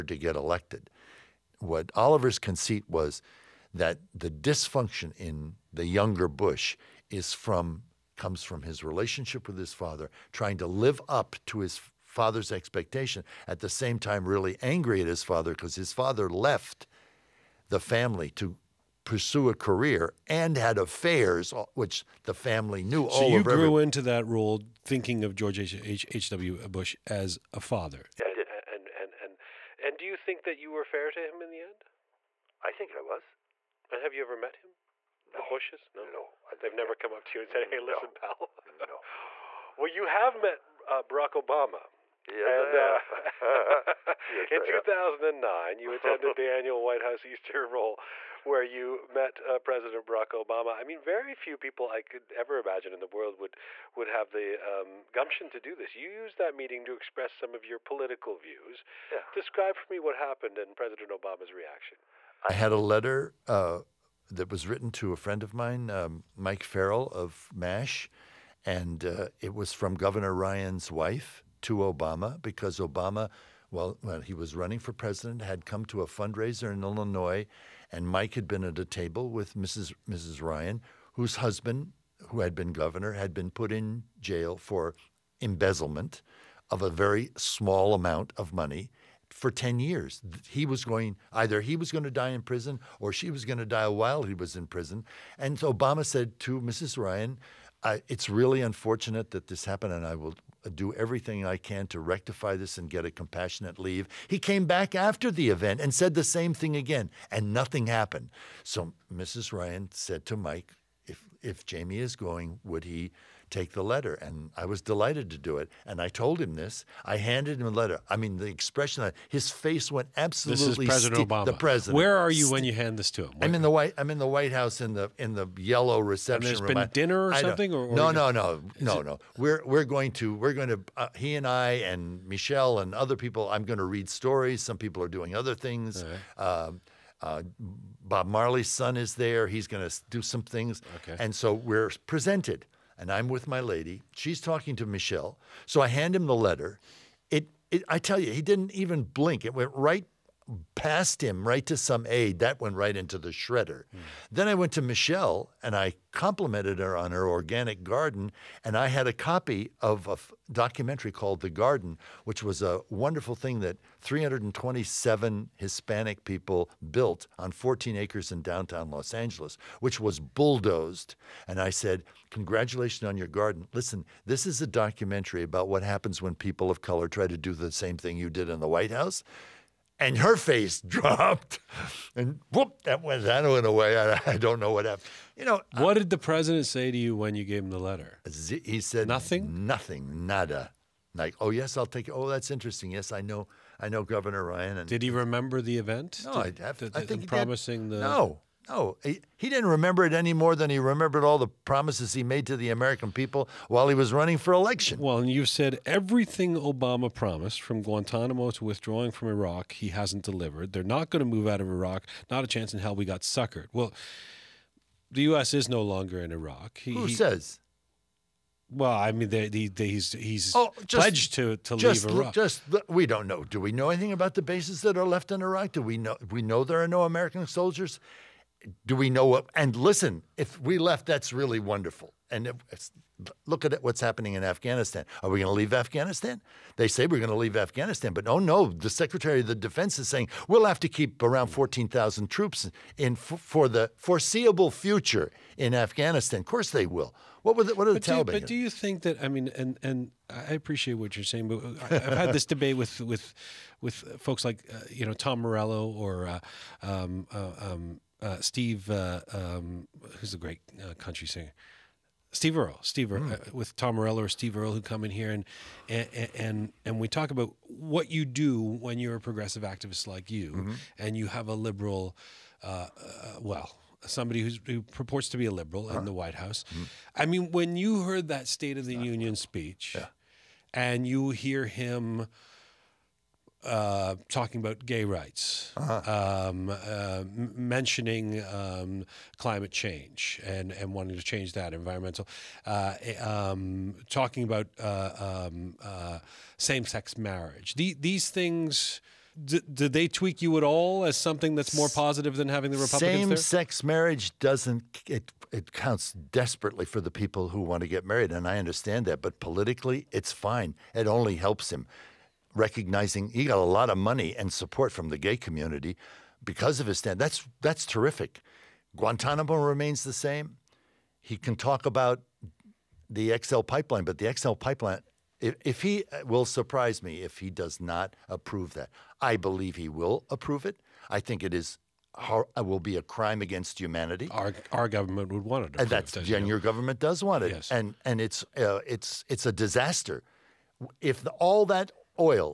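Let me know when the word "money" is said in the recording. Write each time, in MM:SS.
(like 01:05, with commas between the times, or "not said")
01:28, 05:13.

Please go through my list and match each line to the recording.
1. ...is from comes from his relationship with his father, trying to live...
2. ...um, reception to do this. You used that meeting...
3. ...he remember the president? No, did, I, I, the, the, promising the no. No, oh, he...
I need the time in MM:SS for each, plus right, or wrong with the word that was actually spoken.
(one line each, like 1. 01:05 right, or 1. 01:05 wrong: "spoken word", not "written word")
1. 00:07 right
2. 00:54 wrong: "gumption", not "reception"
3. 03:15 wrong: "event", not "president".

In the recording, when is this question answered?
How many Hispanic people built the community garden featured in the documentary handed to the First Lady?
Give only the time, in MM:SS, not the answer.
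02:43.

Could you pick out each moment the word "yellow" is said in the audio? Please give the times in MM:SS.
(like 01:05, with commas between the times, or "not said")
02:05.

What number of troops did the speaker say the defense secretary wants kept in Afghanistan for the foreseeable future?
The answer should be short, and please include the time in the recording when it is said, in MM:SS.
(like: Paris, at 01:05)
14,000, at 04:01.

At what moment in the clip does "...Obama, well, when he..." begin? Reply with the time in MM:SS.
01:12.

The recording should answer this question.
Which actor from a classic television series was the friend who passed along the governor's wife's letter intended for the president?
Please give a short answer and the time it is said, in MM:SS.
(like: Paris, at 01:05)
Mike Farrell, at 01:06.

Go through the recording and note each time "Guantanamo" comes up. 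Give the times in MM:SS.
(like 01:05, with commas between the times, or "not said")
03:27, 05:18.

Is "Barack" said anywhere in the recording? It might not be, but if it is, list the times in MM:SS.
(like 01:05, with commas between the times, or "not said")
00:41, 00:50.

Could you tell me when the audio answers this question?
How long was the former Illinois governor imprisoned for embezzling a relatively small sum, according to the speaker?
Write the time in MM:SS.
01:29.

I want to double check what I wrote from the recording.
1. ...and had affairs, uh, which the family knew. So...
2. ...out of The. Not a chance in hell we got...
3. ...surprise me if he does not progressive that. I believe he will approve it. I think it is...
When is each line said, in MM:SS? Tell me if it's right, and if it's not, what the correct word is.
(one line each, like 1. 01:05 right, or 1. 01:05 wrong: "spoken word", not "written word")
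1. 00:20 right
2. 03:31 wrong: "Iraq", not "The"
3. 05:26 wrong: "approve", not "progressive".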